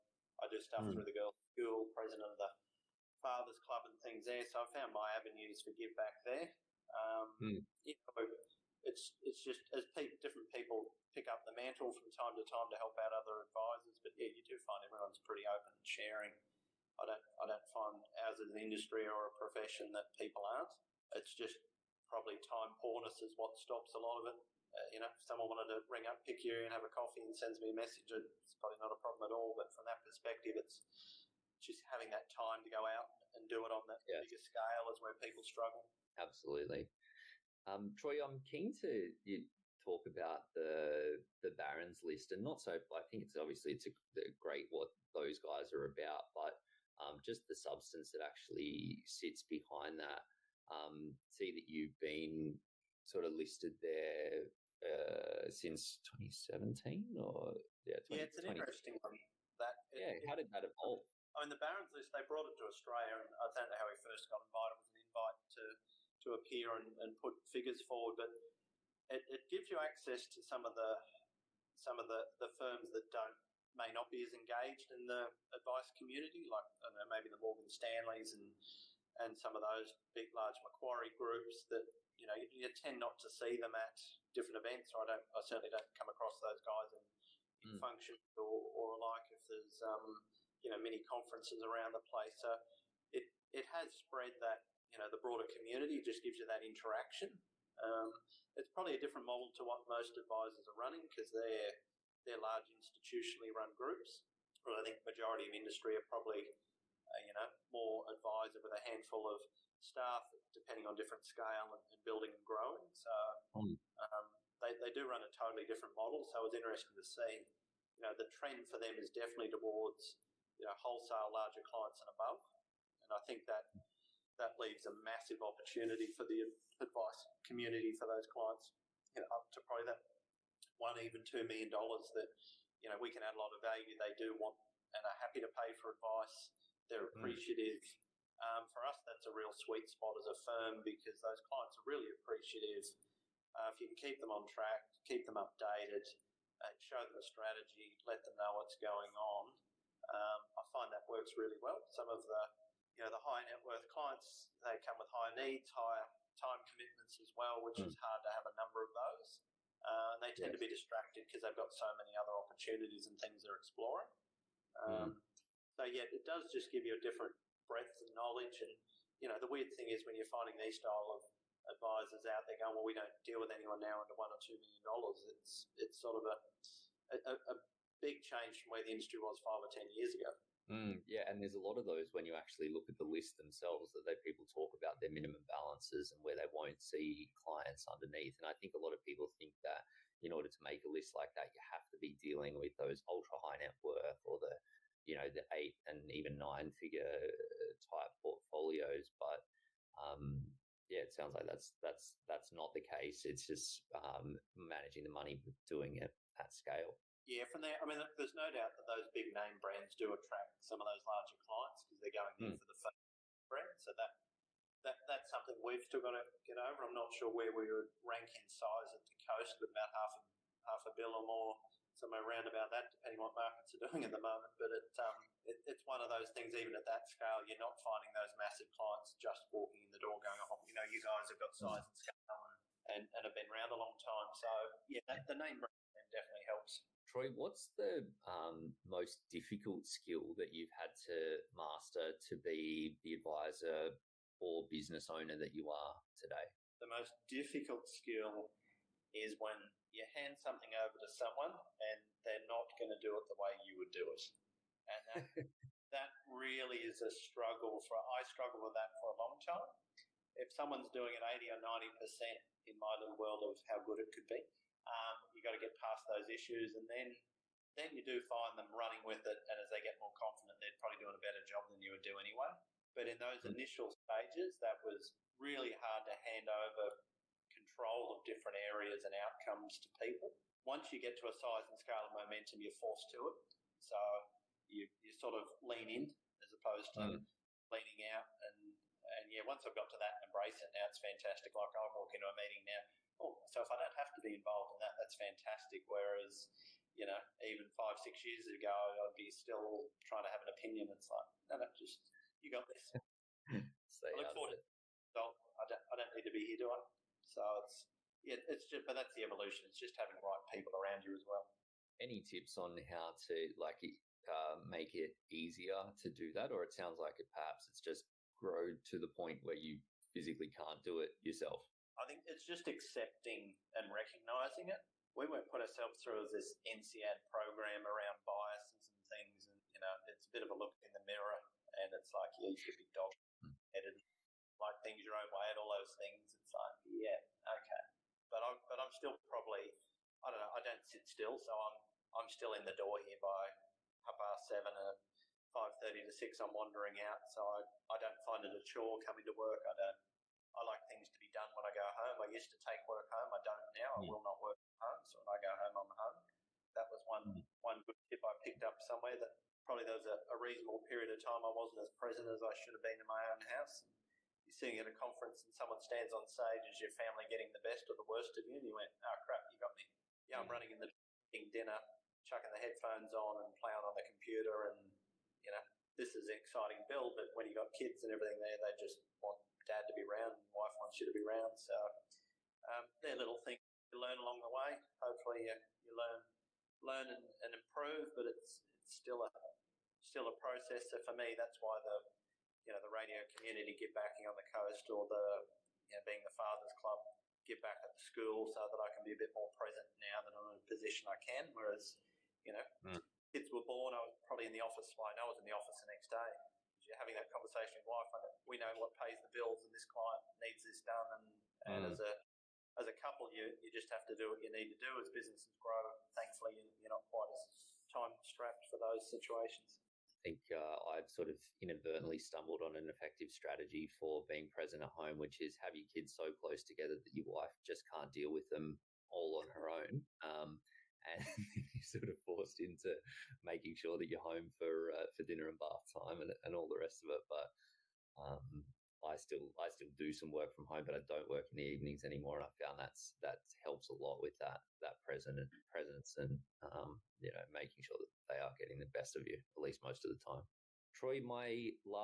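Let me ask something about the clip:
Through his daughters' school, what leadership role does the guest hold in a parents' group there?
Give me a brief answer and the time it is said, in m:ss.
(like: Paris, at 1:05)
President of the fathers' club, at 0:01.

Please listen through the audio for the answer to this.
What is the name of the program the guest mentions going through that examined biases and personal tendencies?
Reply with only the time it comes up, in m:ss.
5:26.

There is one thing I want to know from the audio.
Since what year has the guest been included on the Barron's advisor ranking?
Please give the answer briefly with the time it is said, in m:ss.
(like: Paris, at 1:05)
2017, at 0:56.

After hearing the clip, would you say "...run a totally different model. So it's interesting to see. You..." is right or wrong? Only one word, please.
right.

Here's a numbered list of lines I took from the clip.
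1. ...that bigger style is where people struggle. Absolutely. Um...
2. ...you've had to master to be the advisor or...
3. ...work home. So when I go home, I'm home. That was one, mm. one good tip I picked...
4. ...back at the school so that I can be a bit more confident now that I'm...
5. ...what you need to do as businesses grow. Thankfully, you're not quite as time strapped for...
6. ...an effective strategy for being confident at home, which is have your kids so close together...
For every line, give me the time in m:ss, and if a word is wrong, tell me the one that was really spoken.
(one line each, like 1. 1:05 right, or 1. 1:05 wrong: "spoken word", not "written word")
1. 0:33 wrong: "scale", not "style"
2. 4:00 right
3. 5:54 right
4. 6:37 wrong: "present", not "confident"
5. 6:54 right
6. 7:02 wrong: "present", not "confident".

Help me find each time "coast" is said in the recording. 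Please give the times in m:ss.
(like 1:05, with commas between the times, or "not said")
3:39, 6:34.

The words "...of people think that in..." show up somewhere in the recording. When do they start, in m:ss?
3:08.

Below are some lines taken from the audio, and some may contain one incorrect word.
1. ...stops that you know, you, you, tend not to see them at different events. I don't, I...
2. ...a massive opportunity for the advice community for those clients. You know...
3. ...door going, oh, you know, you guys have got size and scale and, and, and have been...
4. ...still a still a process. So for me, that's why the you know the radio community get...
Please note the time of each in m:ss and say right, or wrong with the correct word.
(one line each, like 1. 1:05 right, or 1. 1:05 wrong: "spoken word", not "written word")
1. 1:21 wrong: "groups", not "stops"
2. 2:04 right
3. 3:49 right
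4. 6:28 right.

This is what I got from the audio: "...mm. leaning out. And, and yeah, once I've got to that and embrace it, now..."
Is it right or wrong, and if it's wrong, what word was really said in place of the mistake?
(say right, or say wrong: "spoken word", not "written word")
right.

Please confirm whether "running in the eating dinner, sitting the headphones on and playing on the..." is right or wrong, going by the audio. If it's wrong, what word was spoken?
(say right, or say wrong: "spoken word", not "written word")
wrong: "chucking", not "sitting".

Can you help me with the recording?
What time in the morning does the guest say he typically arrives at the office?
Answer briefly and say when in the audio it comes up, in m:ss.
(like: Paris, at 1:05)
7:30, at 5:44.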